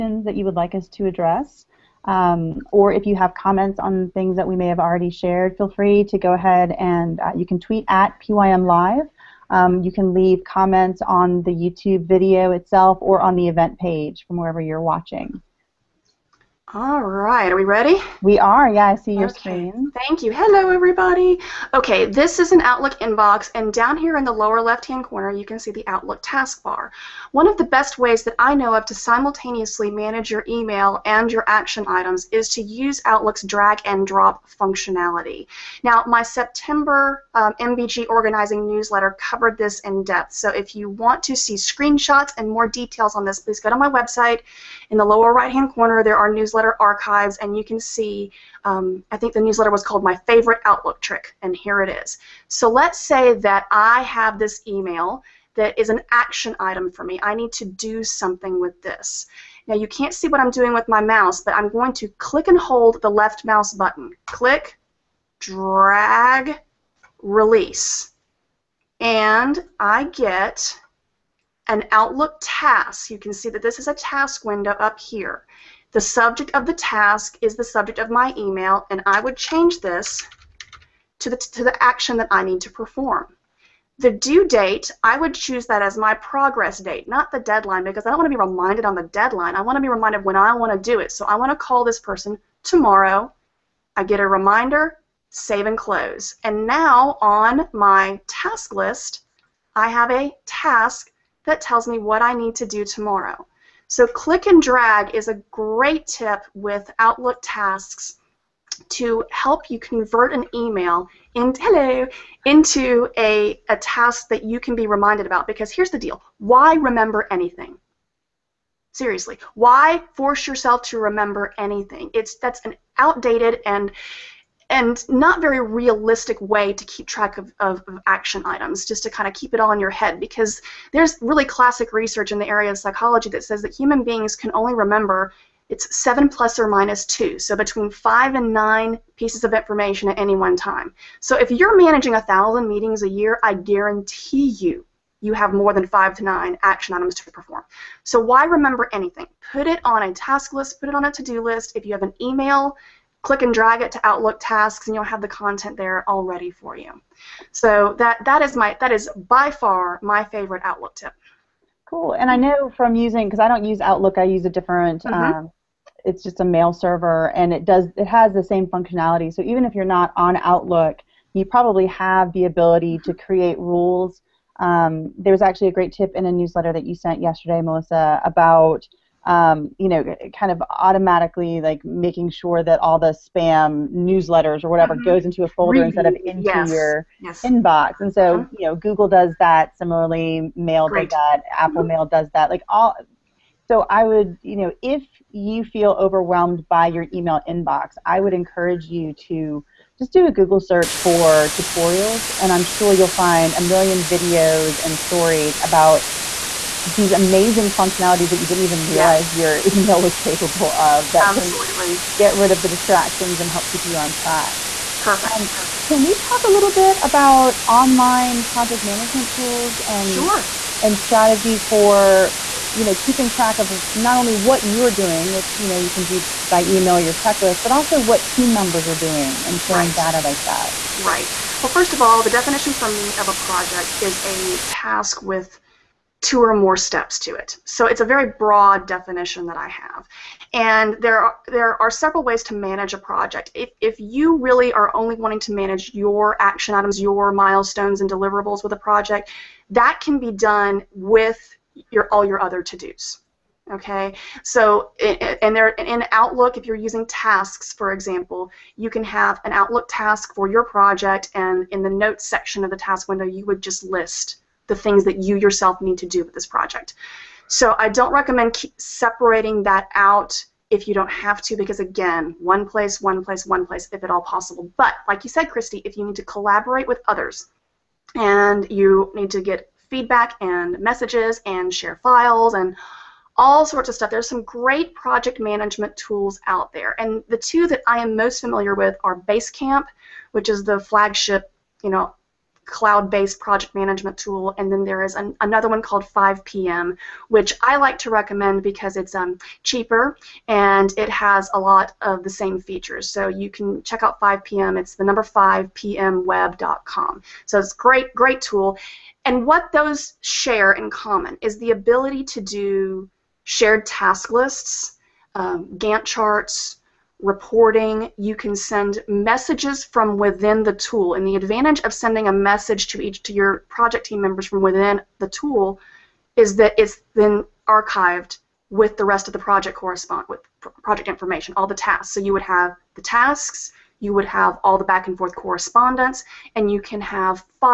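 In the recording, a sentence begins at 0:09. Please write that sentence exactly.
Um, you can leave comments on the YouTube video itself or on the event page from wherever you're watching.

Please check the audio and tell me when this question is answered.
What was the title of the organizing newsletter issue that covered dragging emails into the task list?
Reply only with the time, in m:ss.
0:50.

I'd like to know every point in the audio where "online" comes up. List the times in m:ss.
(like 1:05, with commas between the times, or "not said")
3:37.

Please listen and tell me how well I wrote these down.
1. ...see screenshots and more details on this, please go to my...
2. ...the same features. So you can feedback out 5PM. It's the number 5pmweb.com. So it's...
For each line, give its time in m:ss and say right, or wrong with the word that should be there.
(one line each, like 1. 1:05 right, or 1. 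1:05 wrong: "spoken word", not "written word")
1. 0:41 right
2. 5:02 wrong: "check", not "feedback".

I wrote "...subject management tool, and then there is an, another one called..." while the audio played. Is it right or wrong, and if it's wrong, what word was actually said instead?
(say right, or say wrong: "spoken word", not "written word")
wrong: "project", not "subject".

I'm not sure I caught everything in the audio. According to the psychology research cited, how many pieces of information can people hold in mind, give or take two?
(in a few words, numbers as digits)
7.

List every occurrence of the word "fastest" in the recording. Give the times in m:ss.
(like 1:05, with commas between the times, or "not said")
not said.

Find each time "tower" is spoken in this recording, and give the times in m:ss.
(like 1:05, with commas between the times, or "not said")
not said.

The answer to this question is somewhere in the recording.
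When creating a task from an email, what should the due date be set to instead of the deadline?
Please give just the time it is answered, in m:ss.
1:26.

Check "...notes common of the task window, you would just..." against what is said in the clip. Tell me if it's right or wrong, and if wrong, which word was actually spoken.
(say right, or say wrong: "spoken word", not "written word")
wrong: "section", not "common".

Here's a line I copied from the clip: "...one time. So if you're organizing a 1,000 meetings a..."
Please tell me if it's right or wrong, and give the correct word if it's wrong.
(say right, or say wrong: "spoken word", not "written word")
wrong: "managing", not "organizing".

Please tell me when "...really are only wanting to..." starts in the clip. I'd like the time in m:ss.
4:04.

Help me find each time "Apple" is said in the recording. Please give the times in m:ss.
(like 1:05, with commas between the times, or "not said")
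3:11.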